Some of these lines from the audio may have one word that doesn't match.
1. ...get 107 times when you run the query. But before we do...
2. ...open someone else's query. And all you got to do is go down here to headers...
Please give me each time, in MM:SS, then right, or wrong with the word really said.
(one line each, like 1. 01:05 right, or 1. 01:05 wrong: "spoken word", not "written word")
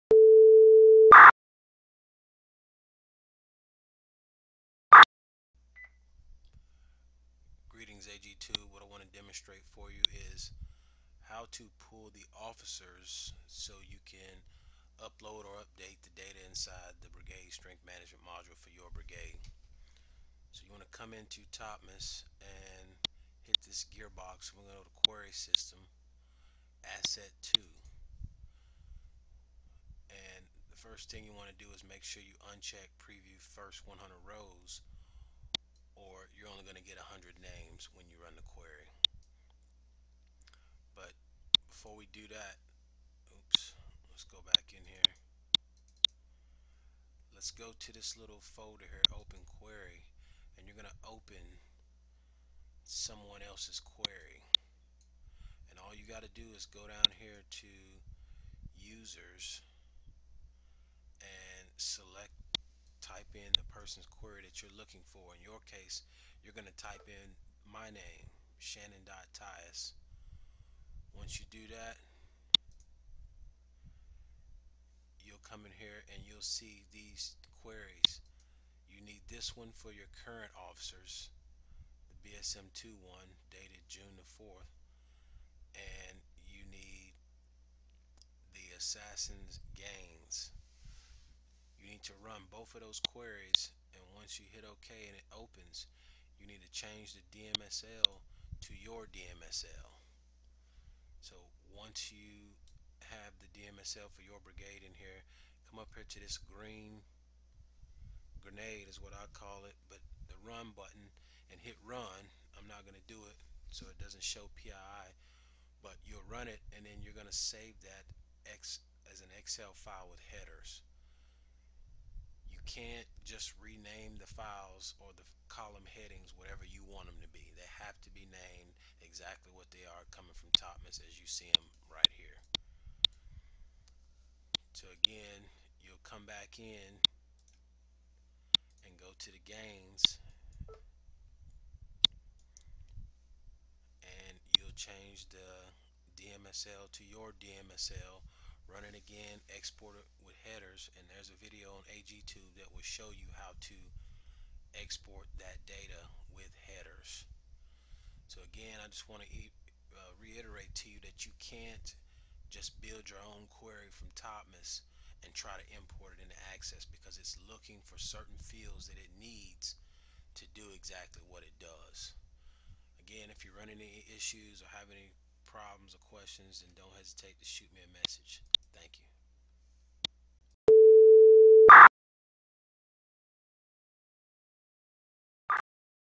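1. 00:36 wrong: "100", not "107"
2. 00:51 wrong: "users", not "headers".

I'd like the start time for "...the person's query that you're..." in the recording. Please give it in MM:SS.
01:03.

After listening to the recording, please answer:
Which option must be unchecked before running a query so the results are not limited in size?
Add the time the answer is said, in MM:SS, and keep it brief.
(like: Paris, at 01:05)
Preview First 100 Rows, at 00:33.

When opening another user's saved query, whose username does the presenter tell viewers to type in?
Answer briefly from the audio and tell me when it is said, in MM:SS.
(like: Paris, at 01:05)
Shannon.Tyus, at 01:08.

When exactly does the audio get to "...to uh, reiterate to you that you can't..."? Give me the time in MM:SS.
02:39.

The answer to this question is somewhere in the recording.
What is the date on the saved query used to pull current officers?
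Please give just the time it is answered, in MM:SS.
01:23.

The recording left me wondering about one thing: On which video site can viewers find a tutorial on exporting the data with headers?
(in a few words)
AGTube.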